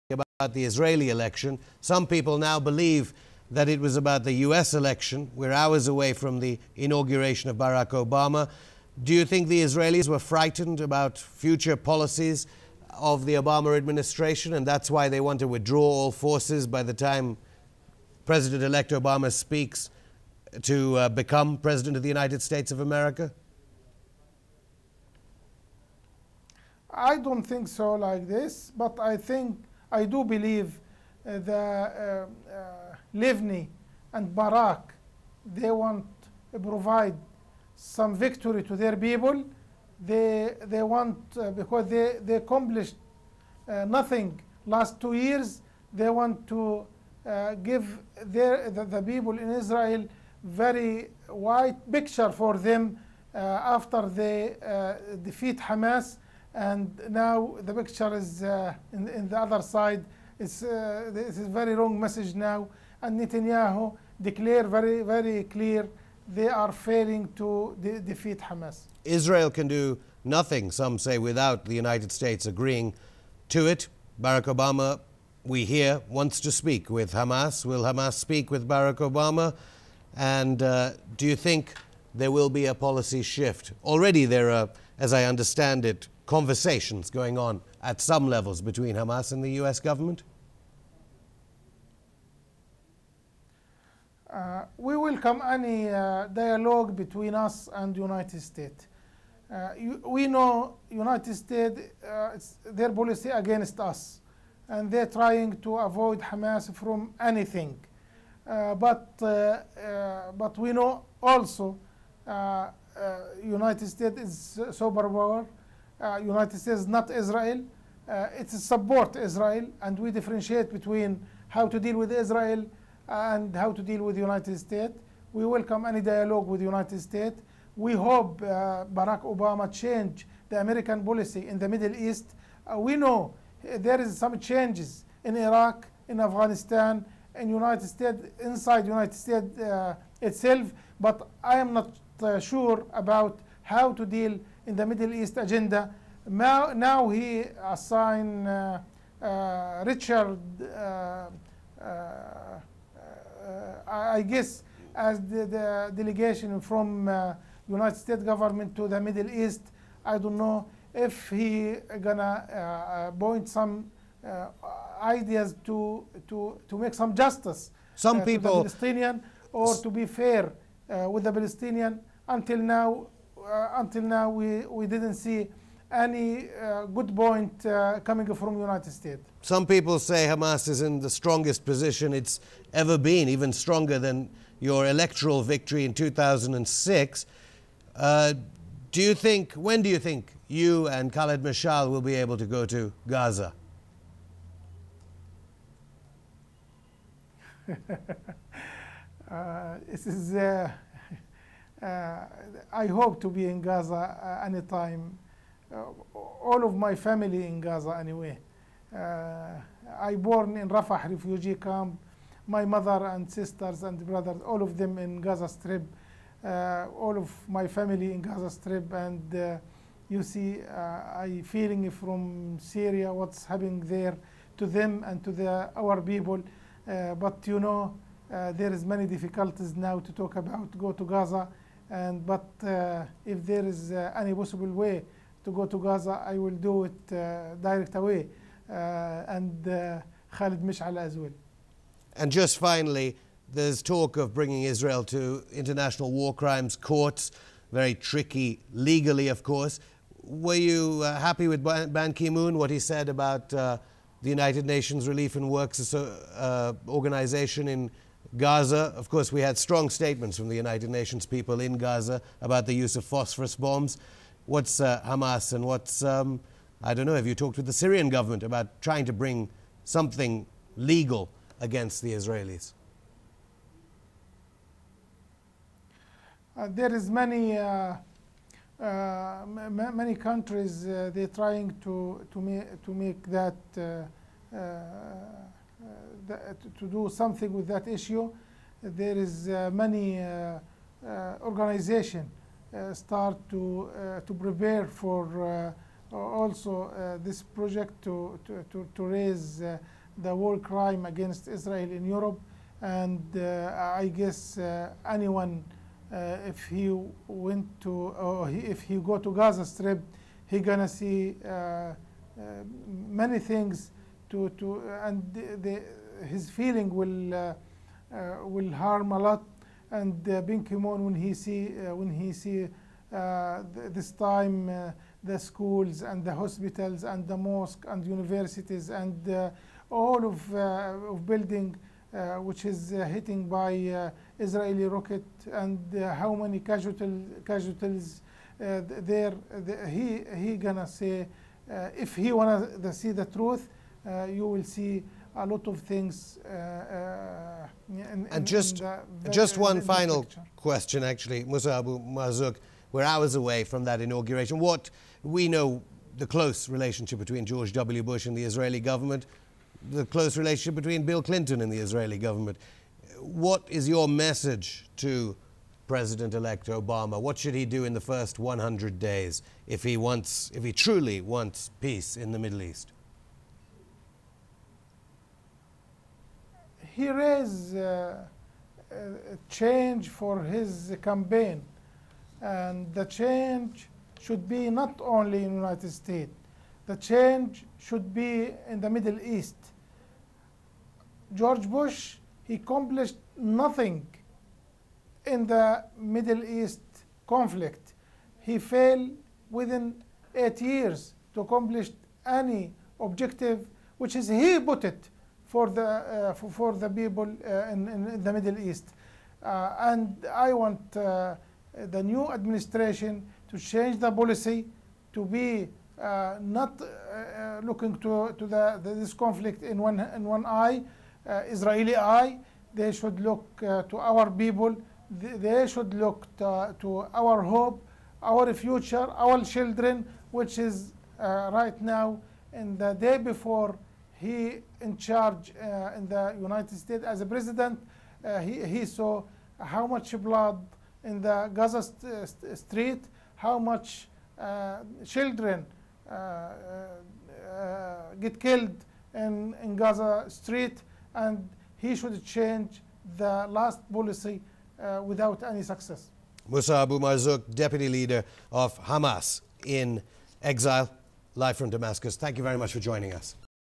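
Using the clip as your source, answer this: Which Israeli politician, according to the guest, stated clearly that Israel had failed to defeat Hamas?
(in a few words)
Netanyahu.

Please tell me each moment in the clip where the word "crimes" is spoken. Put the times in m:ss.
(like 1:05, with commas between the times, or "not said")
4:06, 5:00.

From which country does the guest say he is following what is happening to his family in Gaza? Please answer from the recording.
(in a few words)
Syria.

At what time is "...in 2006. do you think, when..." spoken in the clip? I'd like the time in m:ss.
3:05.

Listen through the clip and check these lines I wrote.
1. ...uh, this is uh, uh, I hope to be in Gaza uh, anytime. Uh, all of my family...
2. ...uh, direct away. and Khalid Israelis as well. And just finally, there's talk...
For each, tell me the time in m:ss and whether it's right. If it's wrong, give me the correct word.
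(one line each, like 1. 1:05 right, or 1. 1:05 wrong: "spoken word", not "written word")
1. 3:19 right
2. 3:57 wrong: "Mishal", not "Israelis".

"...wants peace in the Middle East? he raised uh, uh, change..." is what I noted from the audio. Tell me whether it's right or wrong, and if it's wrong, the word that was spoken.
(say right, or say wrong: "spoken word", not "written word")
right.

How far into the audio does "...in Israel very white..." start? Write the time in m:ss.
0:49.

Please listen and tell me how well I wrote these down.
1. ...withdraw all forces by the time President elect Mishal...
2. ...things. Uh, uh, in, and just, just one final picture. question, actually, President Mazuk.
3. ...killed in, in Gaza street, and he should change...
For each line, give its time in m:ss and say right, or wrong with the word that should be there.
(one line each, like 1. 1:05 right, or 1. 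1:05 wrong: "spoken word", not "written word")
1. 0:15 wrong: "Obama", not "Mishal"
2. 5:45 wrong: "Musabu", not "President"
3. 7:28 right.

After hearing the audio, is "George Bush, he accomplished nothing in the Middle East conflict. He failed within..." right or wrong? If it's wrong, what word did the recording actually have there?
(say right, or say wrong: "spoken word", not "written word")
right.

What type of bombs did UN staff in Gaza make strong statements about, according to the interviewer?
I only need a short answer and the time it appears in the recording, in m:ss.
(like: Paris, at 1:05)
phosphorus bombs, at 4:23.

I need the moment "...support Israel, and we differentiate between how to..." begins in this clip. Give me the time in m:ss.
1:58.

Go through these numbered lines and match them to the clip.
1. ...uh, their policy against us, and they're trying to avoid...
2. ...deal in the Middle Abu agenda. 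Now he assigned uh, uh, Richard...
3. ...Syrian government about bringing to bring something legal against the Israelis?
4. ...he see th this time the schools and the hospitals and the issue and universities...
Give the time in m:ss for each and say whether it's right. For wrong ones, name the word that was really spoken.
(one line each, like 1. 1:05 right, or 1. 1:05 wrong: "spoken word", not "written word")
1. 1:42 right
2. 2:24 wrong: "East", not "Abu"
3. 4:27 wrong: "trying", not "bringing"
4. 5:22 wrong: "mosque", not "issue".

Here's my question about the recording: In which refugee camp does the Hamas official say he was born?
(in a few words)
Rafah refugee camp.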